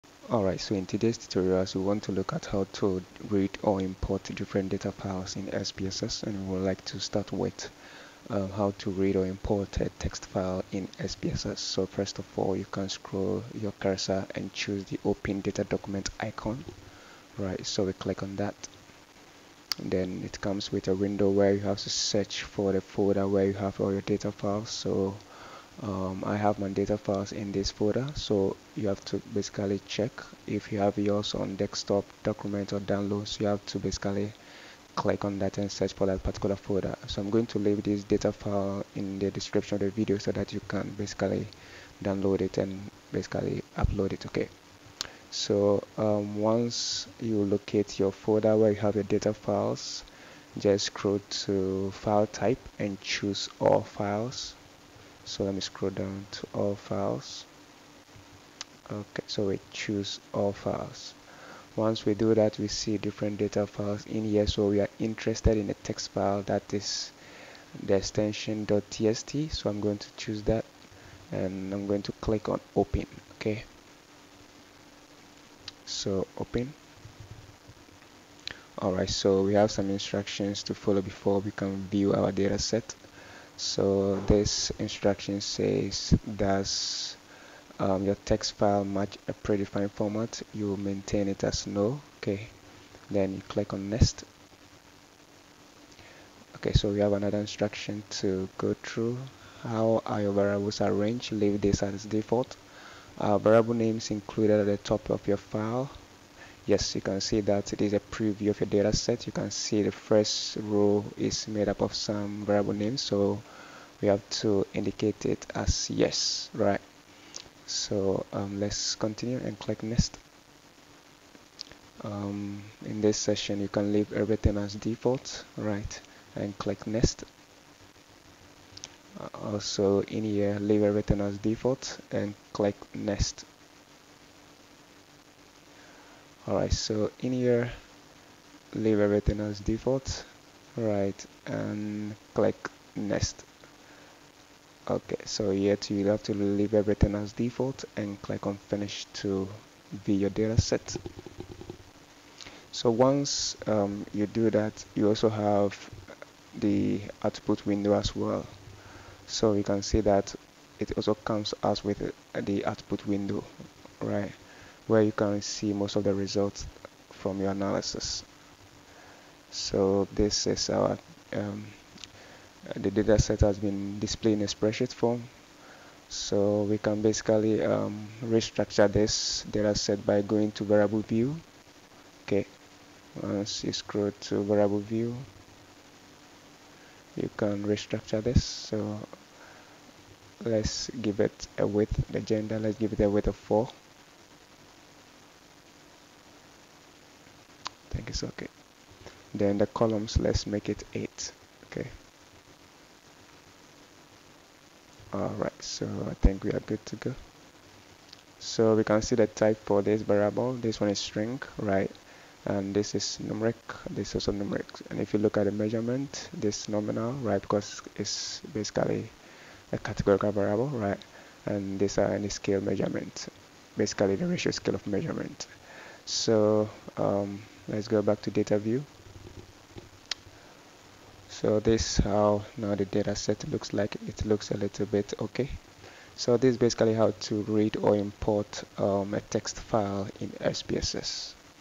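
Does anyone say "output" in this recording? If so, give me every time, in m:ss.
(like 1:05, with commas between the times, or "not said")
2:37, 2:42.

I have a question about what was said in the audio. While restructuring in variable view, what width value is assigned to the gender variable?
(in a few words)
4.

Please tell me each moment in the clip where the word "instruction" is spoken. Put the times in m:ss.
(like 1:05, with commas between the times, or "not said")
1:19, 1:24, 1:37.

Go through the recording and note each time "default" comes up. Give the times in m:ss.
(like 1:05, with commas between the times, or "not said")
1:42, 2:04, 2:11, 2:19, 2:27.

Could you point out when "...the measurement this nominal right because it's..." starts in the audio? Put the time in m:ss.
3:35.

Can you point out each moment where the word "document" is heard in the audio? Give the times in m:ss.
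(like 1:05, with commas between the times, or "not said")
0:15, 0:32.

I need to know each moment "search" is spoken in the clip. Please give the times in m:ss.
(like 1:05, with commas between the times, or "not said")
0:21, 0:35.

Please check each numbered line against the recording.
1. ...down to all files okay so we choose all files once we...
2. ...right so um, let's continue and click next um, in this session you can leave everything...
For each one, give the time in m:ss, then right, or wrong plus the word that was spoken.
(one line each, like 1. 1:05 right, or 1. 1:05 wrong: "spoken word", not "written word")
1. 0:55 right
2. 1:56 right.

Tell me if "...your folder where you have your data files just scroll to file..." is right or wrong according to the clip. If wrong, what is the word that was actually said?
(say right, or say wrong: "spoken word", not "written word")
right.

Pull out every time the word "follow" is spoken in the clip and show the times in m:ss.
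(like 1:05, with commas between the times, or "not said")
1:20.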